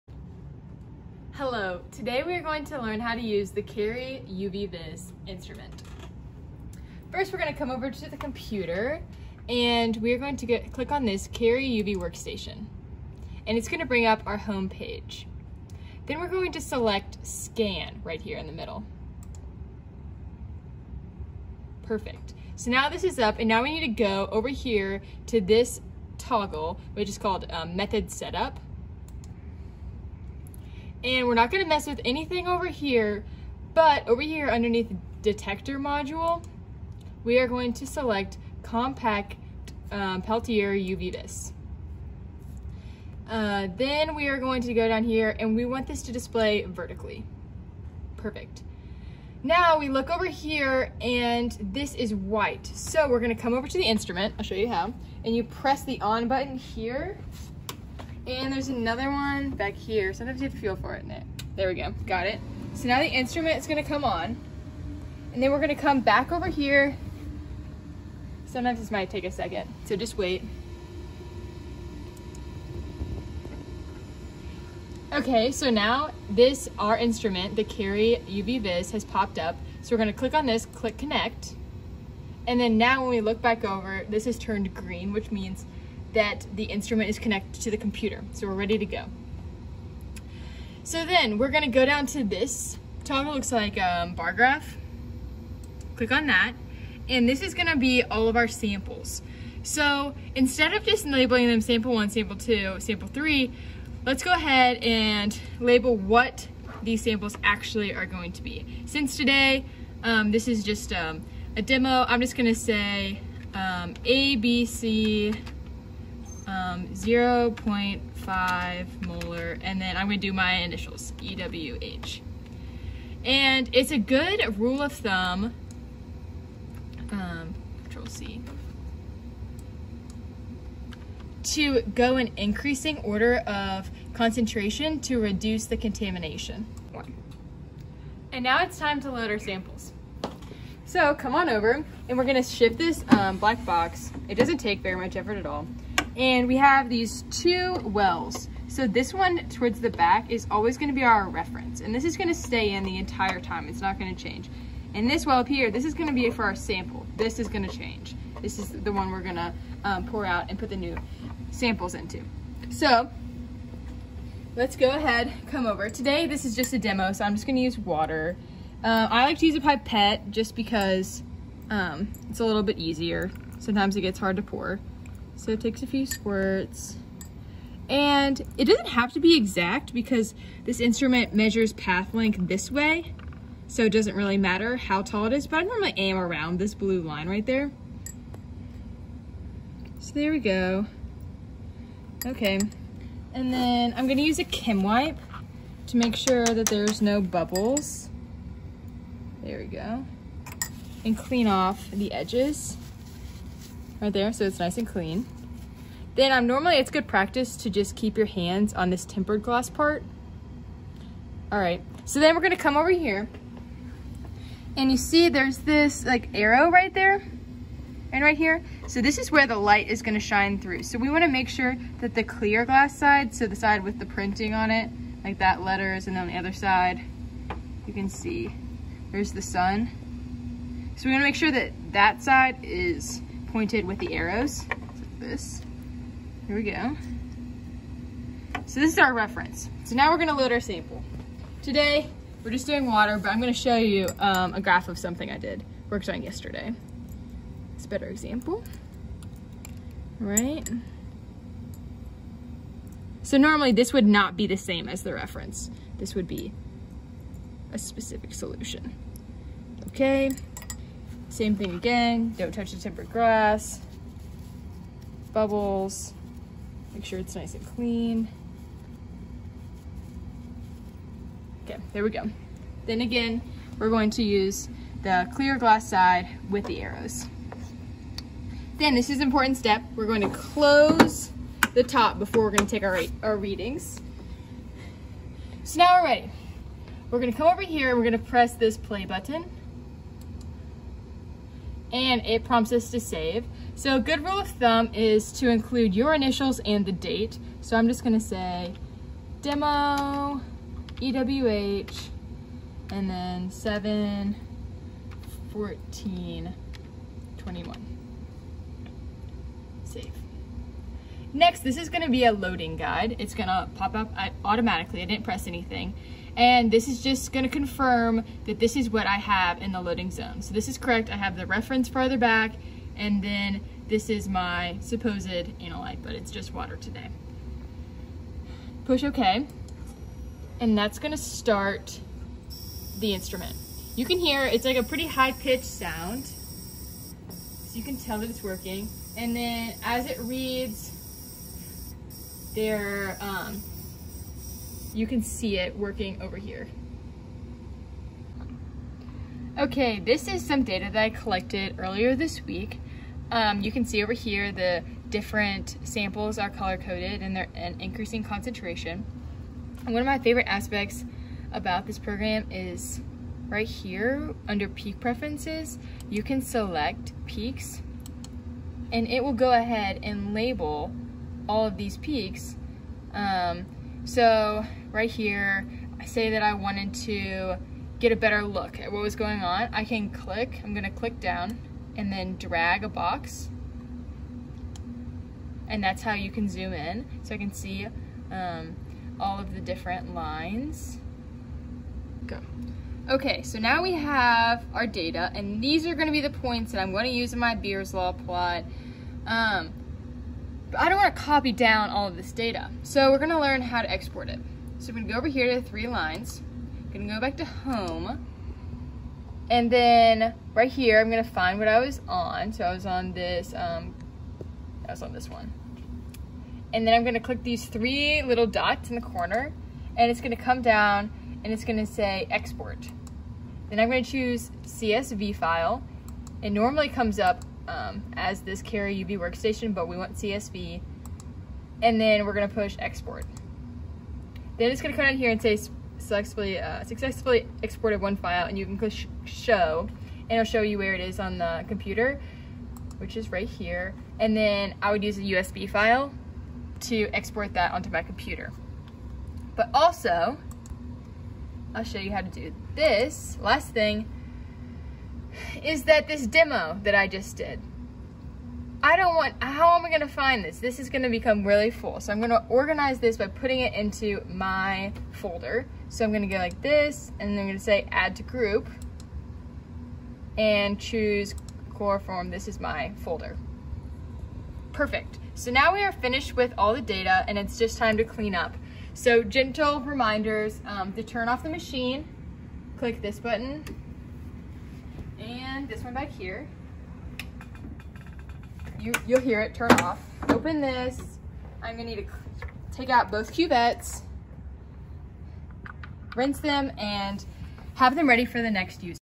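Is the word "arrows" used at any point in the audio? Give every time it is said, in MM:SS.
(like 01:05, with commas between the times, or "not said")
03:36, 03:54, 04:36.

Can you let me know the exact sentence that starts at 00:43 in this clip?
Uh, then we are going to go down here and we want this to display vertically.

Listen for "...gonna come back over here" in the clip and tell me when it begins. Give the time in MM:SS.
01:05.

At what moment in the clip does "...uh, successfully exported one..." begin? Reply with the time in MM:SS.
07:16.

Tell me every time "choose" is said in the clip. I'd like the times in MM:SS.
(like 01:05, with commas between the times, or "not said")
07:04, 07:50.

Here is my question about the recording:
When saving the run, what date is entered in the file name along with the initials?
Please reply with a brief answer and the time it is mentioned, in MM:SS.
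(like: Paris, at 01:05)
7/14/21, at 05:03.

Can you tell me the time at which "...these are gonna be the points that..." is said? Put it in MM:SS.
06:35.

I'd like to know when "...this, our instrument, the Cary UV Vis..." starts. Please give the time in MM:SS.
01:16.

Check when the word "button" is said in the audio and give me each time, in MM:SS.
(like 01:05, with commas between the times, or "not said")
00:56, 04:49, 08:03.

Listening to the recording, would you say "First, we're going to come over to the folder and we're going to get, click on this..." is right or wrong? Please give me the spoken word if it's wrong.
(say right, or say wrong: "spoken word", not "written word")
wrong: "computer", not "folder".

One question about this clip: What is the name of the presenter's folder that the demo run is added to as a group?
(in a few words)
core form.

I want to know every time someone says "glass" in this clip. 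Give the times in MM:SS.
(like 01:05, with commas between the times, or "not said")
03:29, 03:42, 04:23, 04:35.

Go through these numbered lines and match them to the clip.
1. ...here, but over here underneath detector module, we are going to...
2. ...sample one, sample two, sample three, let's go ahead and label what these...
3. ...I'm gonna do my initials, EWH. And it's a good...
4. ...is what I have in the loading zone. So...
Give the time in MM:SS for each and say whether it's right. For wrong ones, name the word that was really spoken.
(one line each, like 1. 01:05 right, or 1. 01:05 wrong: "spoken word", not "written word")
1. 00:32 right
2. 01:41 right
3. 01:59 right
4. 05:18 right.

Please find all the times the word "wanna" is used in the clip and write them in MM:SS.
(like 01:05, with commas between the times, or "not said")
03:41, 03:51.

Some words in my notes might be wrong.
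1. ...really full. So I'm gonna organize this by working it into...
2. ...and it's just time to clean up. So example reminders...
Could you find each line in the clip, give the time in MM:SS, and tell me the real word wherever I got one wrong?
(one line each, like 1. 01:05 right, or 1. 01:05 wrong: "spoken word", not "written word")
1. 07:41 wrong: "putting", not "working"
2. 07:57 wrong: "gentle", not "example".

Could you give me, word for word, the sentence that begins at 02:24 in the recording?
It doesn't take very much effort at all.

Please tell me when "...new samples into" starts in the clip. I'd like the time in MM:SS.
02:40.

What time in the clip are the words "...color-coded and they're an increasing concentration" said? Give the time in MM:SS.
05:56.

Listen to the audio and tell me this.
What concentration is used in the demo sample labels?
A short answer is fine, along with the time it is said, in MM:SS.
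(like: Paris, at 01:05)
0.5 molar, at 01:56.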